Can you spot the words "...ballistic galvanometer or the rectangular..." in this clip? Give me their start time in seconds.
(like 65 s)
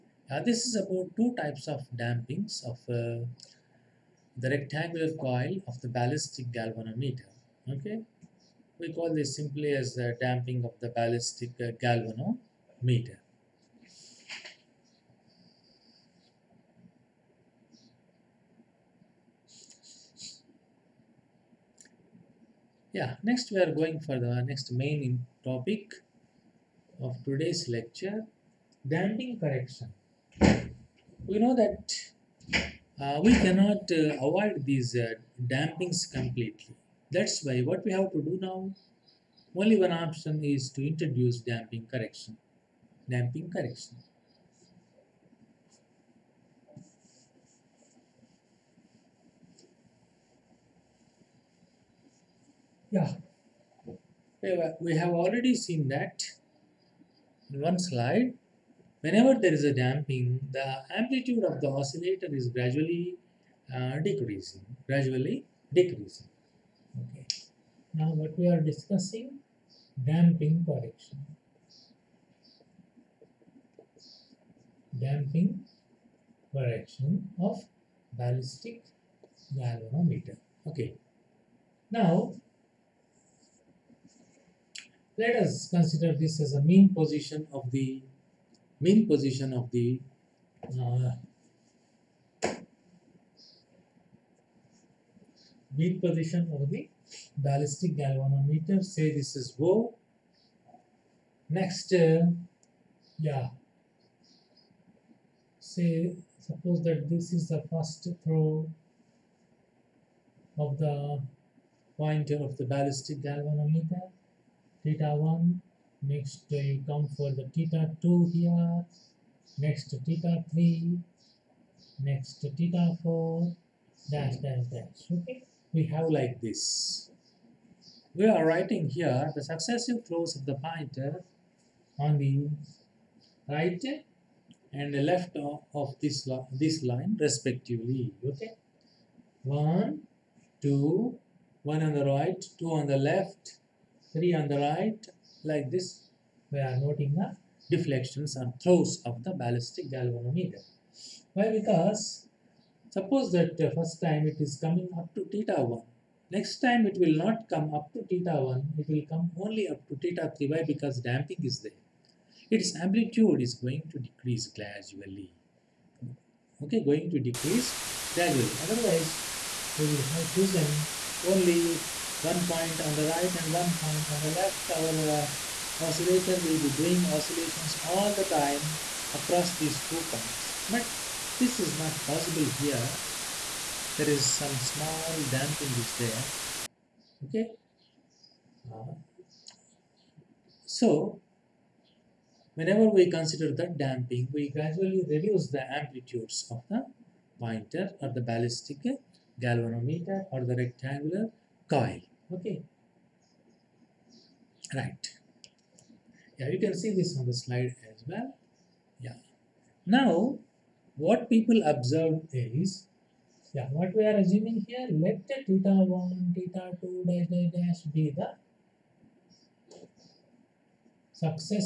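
198 s.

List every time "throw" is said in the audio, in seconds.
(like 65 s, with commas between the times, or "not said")
108 s, 148 s.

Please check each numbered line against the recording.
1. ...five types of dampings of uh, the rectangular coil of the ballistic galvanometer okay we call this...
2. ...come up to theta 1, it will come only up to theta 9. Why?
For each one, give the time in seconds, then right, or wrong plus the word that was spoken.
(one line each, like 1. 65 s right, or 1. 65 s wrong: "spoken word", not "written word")
1. 1 s wrong: "two", not "five"
2. 157 s wrong: "3", not "9".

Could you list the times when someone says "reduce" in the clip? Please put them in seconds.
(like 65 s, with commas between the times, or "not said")
195 s.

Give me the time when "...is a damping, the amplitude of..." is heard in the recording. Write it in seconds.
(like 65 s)
59 s.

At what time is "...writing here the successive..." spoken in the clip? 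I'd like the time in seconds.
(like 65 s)
128 s.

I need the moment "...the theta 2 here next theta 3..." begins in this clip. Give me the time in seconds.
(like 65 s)
117 s.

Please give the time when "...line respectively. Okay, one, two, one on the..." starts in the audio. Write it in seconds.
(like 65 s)
136 s.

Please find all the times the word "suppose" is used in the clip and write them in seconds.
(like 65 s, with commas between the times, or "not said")
106 s, 152 s.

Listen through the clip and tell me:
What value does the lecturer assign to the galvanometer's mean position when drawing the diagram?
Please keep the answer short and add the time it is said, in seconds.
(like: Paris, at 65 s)
0, at 99 s.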